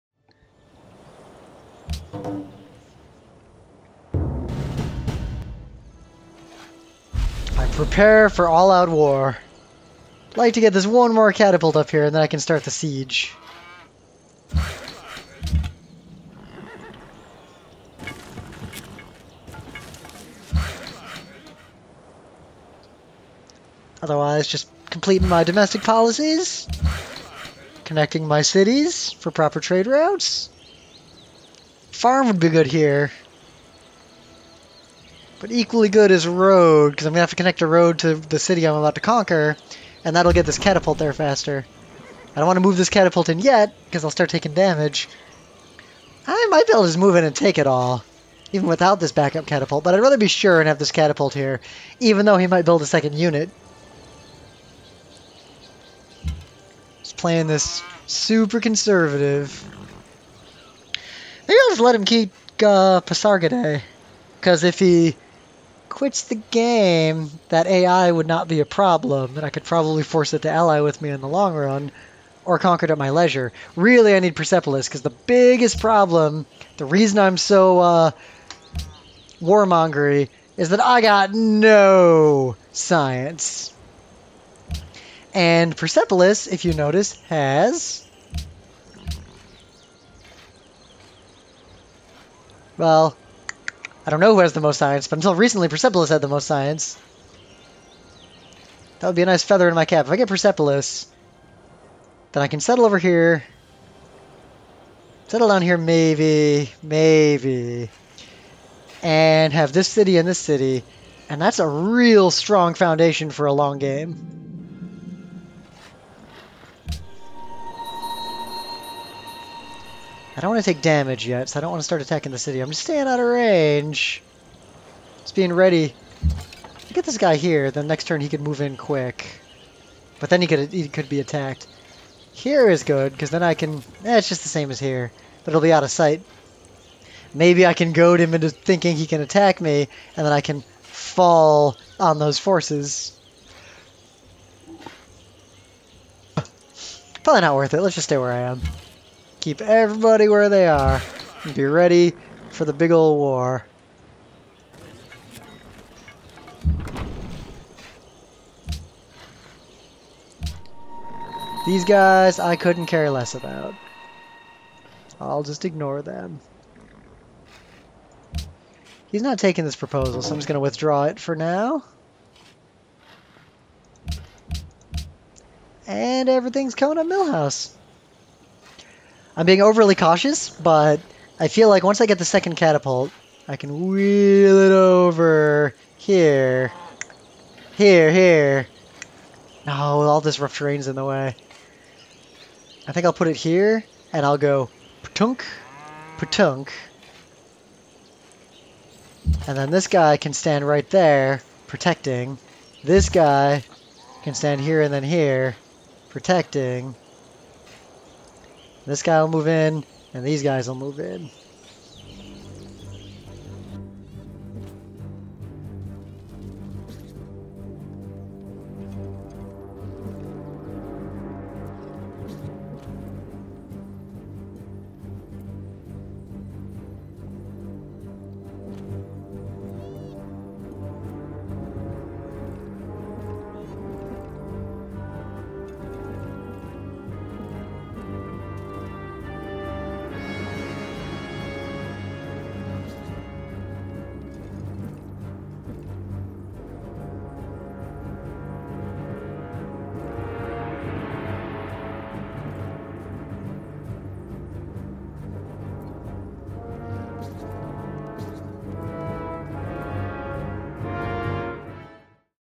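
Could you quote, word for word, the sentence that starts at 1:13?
Really, I need Persepolis, because the biggest problem, the reason I'm so uh, warmongery, is that I got no science.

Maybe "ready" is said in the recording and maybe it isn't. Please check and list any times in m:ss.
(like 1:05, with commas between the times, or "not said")
2:05, 2:31.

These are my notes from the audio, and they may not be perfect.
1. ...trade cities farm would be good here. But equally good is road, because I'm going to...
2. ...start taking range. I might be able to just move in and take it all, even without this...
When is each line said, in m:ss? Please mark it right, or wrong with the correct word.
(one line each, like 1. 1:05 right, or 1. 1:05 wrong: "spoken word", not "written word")
1. 0:29 wrong: "routes", not "cities"
2. 0:44 wrong: "damage", not "range".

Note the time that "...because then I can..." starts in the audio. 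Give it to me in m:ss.
2:13.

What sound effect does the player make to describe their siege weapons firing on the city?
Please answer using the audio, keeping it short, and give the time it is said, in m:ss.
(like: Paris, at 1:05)
patunk, patunk, at 3:15.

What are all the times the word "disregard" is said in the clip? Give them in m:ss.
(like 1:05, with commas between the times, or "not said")
not said.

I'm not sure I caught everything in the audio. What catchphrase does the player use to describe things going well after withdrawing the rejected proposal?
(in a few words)
everything's coming up Milhouse.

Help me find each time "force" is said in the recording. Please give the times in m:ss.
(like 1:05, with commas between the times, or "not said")
1:10, 2:22.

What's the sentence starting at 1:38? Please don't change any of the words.
That would be a nice feather in my cap.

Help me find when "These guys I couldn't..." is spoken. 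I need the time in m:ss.
2:41.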